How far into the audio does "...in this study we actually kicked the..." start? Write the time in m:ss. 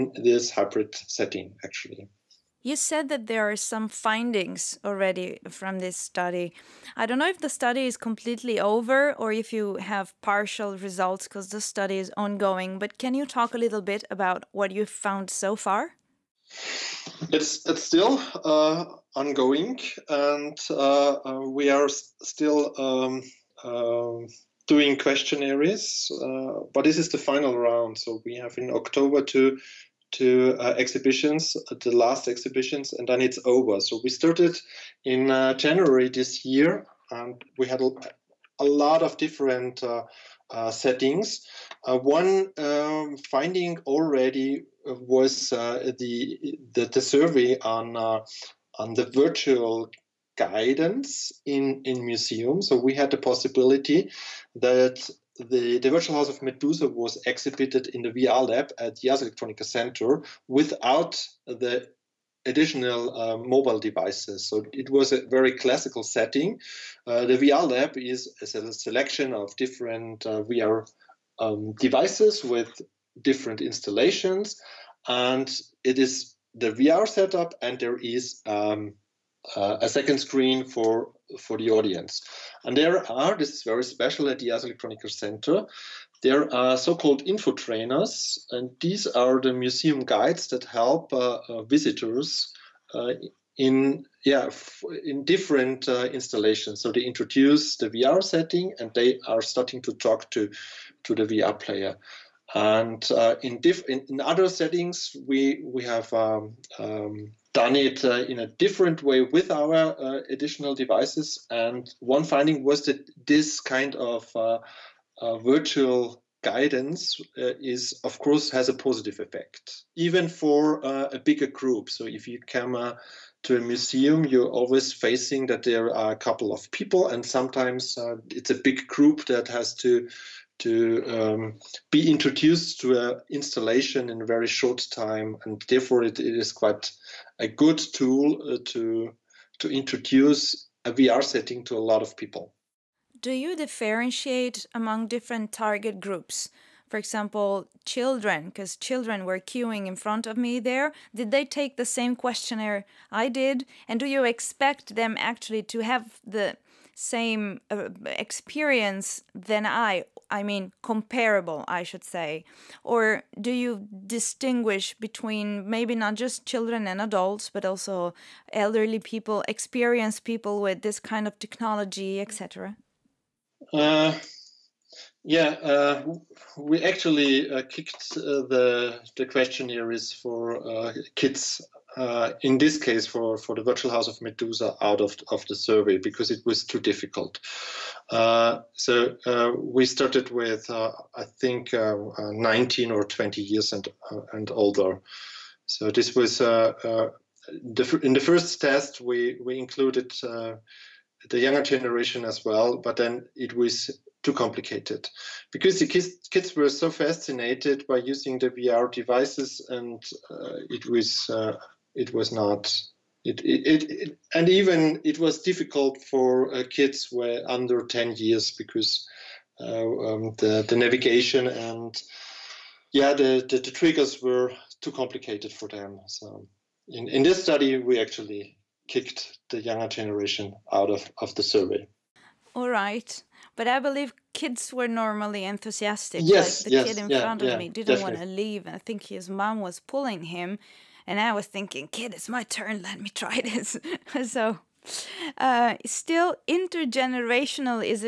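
3:47.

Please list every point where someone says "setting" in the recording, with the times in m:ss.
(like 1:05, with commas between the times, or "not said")
0:00, 0:40, 1:06, 1:38, 1:44, 2:21.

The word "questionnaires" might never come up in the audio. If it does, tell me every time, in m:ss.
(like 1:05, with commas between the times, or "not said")
0:24, 2:32, 2:59.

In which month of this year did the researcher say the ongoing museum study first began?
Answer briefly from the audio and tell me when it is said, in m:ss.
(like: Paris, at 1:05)
January, at 0:35.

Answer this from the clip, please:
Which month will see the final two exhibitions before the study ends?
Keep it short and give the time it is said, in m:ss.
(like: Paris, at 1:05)
October, at 0:28.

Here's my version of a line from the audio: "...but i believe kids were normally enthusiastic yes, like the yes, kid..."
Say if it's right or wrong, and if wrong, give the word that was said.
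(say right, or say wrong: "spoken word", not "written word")
right.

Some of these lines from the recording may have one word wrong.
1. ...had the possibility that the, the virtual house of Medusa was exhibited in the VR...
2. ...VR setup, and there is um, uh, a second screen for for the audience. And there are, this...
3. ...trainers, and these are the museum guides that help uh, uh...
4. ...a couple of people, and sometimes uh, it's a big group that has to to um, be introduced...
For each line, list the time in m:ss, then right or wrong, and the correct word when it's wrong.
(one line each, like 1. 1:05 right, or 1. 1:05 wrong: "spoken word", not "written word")
1. 0:52 right
2. 1:16 right
3. 1:27 right
4. 2:06 right.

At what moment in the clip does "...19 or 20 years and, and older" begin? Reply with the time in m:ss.
3:12.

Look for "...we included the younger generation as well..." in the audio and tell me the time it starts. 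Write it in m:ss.
3:19.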